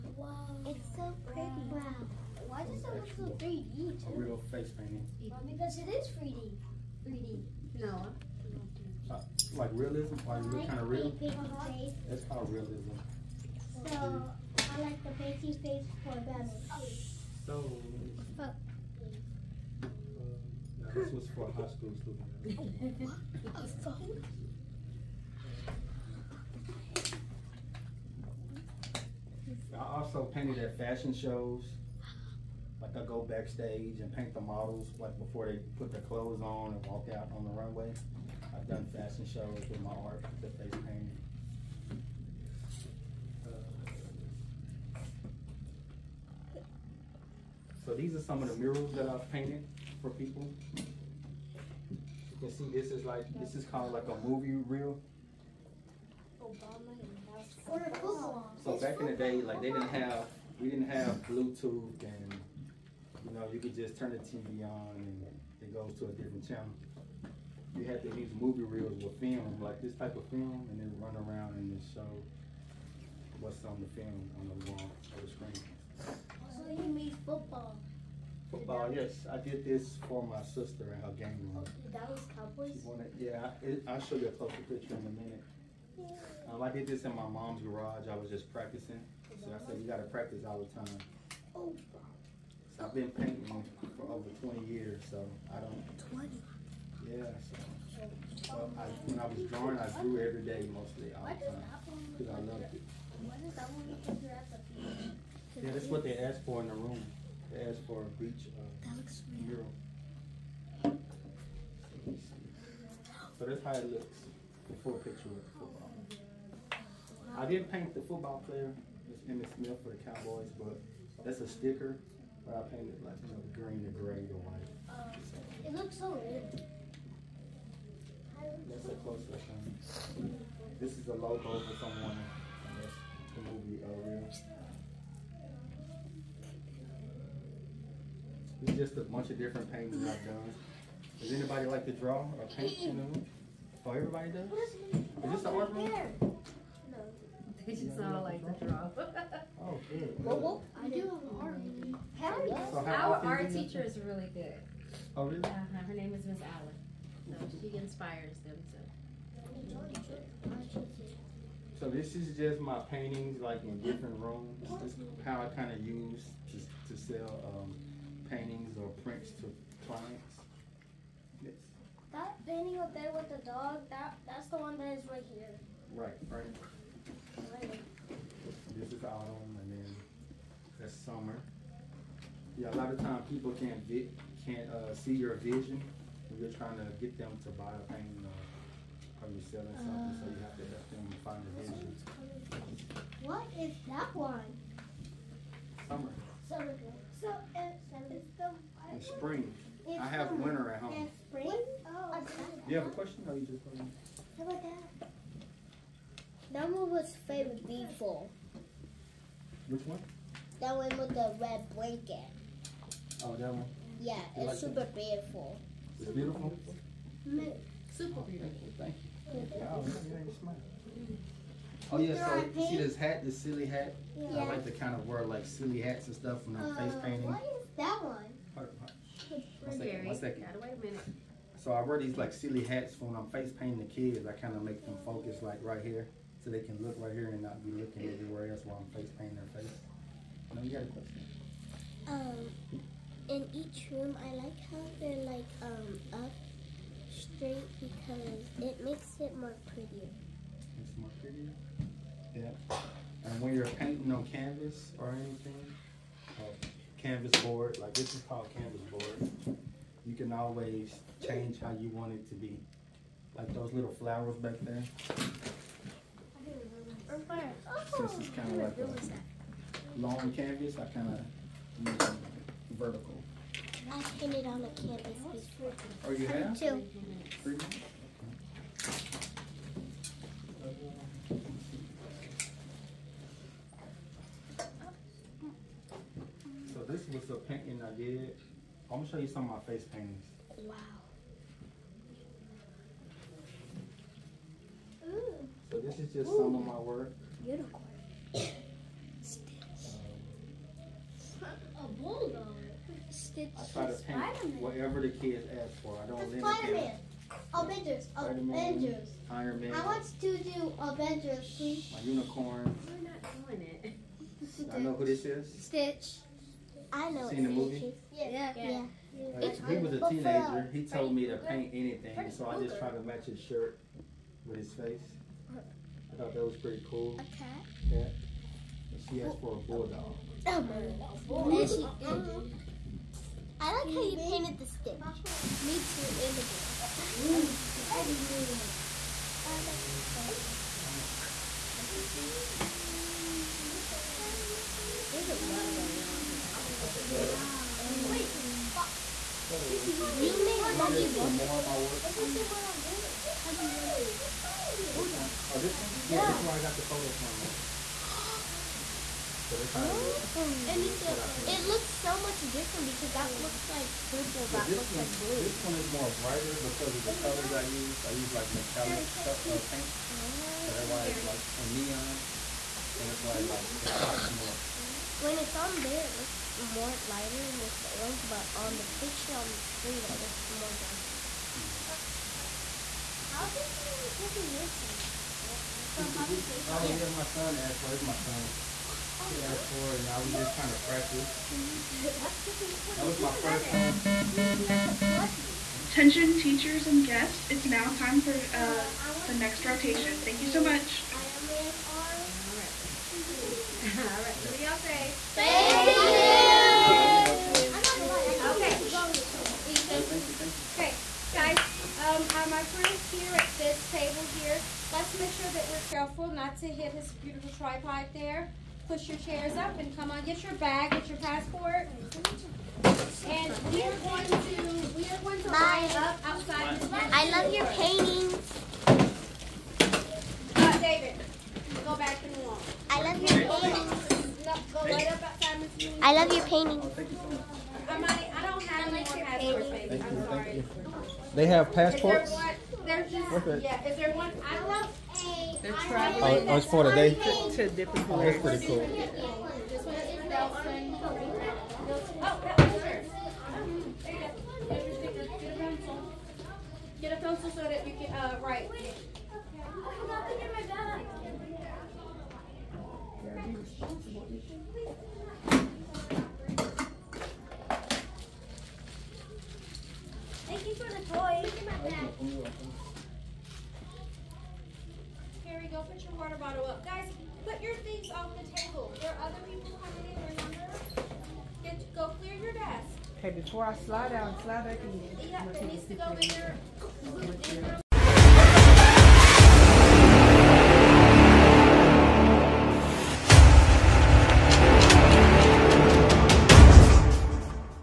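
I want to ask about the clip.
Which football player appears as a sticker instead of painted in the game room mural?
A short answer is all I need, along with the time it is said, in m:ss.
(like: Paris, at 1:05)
Emmitt Smith, at 1:59.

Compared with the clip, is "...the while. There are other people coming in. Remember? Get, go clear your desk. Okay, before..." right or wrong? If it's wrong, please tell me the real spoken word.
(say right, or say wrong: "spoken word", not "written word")
wrong: "table", not "while".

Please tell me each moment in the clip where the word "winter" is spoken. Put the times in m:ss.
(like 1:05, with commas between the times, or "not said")
3:20.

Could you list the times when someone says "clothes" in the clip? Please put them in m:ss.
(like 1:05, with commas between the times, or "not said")
0:36.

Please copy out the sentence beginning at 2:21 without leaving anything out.
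Does anybody like to draw or paint in the Oh, everybody does?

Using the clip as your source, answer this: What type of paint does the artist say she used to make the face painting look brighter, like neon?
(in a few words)
Metallic.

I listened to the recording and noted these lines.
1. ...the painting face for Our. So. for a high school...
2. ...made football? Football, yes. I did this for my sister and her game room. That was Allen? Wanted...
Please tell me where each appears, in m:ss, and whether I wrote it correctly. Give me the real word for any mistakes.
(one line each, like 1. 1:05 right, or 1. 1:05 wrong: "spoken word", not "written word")
1. 0:15 wrong: "Bella", not "Our"
2. 1:16 wrong: "Cowboys", not "Allen".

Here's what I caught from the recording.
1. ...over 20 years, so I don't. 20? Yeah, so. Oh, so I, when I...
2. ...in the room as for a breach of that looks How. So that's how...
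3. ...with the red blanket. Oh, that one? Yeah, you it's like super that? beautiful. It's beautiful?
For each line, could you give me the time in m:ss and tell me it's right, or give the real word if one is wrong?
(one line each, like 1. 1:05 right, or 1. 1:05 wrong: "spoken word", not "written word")
1. 1:34 right
2. 1:46 wrong: "Mural", not "How"
3. 3:30 right.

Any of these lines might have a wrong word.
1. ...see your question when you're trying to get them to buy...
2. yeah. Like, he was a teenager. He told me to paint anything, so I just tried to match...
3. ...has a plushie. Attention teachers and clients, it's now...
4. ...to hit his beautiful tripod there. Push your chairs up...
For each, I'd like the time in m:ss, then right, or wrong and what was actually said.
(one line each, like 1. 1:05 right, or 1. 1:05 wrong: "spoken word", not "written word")
1. 3:04 wrong: "vision", not "question"
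2. 5:19 right
3. 6:34 wrong: "guests", not "clients"
4. 6:56 right.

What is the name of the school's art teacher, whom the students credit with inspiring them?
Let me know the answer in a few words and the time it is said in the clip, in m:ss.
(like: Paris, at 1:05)
Miss Allen, at 2:36.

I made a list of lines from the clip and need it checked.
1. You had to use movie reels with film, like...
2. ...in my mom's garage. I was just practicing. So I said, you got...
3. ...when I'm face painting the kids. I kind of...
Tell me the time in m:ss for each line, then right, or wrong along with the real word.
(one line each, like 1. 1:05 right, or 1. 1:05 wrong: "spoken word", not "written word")
1. 1:07 right
2. 1:27 right
3. 3:53 right.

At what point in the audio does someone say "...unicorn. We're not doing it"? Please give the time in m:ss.
5:12.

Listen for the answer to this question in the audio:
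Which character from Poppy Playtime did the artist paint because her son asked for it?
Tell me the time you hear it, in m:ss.
6:24.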